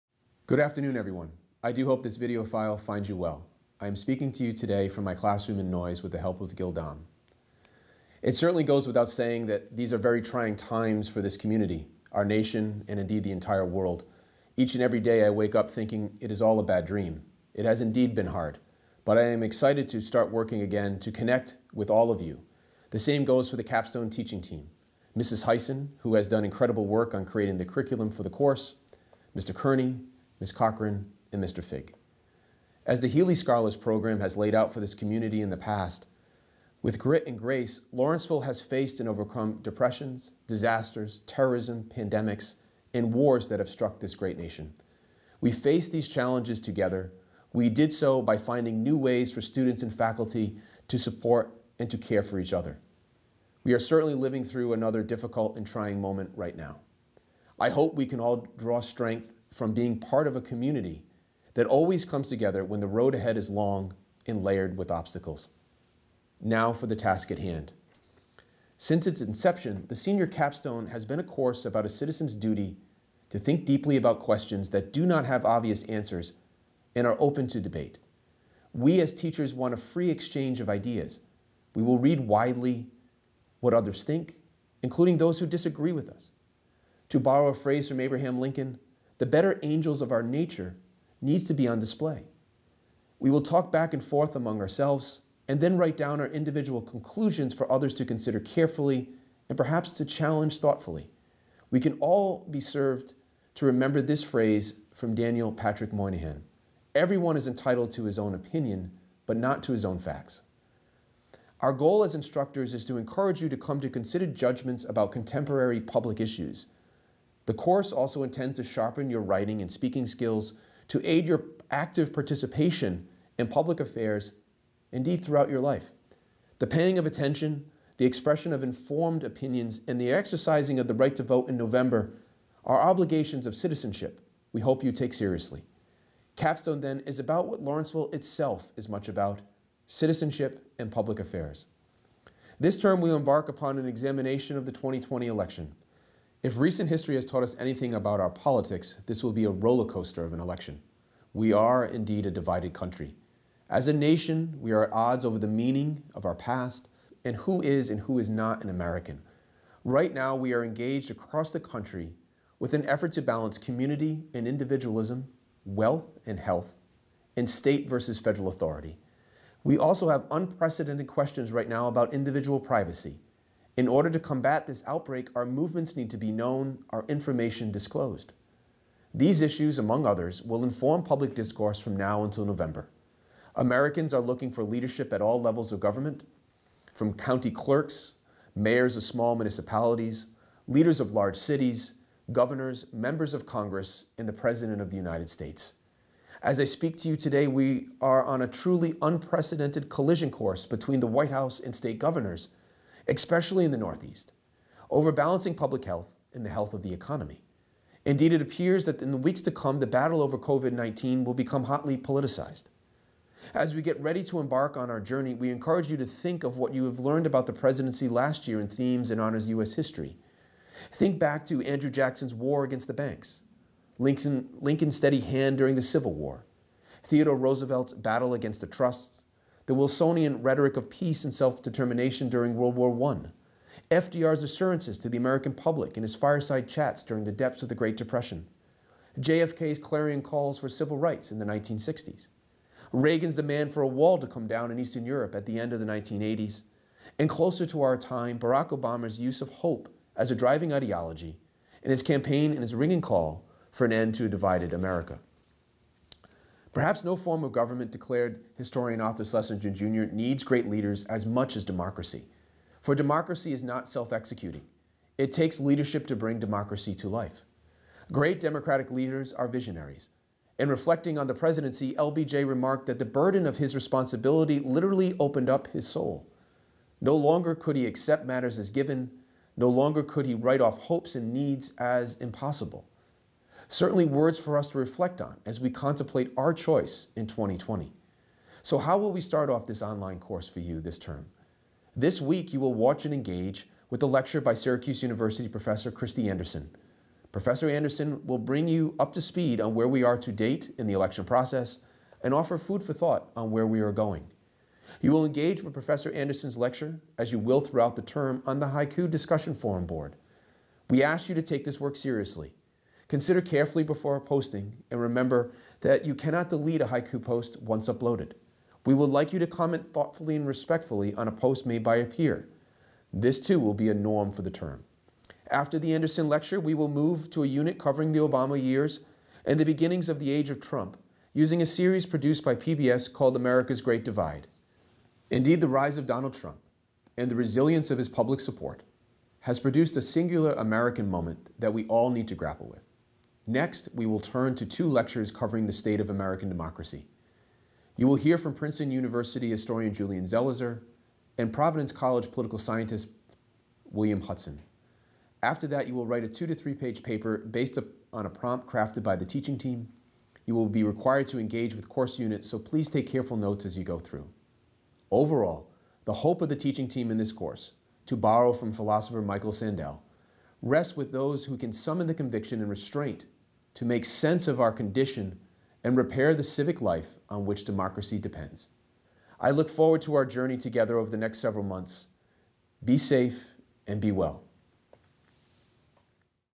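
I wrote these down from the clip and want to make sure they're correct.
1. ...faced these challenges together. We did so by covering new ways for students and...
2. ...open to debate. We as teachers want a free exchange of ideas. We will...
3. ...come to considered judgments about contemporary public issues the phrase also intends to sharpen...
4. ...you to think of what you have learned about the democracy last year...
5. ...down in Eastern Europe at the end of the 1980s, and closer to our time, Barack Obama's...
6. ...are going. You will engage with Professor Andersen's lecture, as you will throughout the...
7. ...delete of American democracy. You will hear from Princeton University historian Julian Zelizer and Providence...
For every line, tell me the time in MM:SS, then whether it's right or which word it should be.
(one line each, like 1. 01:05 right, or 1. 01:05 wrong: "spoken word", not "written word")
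1. 00:45 wrong: "finding", not "covering"
2. 01:17 right
3. 01:53 wrong: "course", not "phrase"
4. 03:35 wrong: "presidency", not "democracy"
5. 04:04 right
6. 05:03 right
7. 05:45 wrong: "state", not "delete".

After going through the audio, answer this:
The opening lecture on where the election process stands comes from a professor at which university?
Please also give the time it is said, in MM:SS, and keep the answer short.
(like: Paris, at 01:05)
Syracuse University, at 04:54.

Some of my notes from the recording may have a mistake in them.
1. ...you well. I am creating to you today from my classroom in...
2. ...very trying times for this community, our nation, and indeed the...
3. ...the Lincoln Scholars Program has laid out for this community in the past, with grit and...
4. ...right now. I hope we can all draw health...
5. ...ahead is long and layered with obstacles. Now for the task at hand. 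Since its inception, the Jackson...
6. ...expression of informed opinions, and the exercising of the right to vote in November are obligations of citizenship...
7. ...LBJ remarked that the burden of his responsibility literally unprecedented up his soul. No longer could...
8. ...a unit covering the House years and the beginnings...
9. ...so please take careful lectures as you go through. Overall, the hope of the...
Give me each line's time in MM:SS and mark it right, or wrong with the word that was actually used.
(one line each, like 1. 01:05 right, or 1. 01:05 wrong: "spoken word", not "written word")
1. 00:03 wrong: "speaking", not "creating"
2. 00:09 right
3. 00:32 wrong: "Healy", not "Lincoln"
4. 00:56 wrong: "strength", not "health"
5. 01:03 wrong: "Senior", not "Jackson"
6. 02:08 right
7. 04:31 wrong: "opened", not "unprecedented"
8. 05:27 wrong: "Obama", not "House"
9. 06:02 wrong: "notes", not "lectures".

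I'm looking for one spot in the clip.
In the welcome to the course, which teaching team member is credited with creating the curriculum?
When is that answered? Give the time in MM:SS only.
00:25.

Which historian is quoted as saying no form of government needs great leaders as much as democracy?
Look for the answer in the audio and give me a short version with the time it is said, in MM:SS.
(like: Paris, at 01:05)
Arthur Schlesinger Jr., at 04:19.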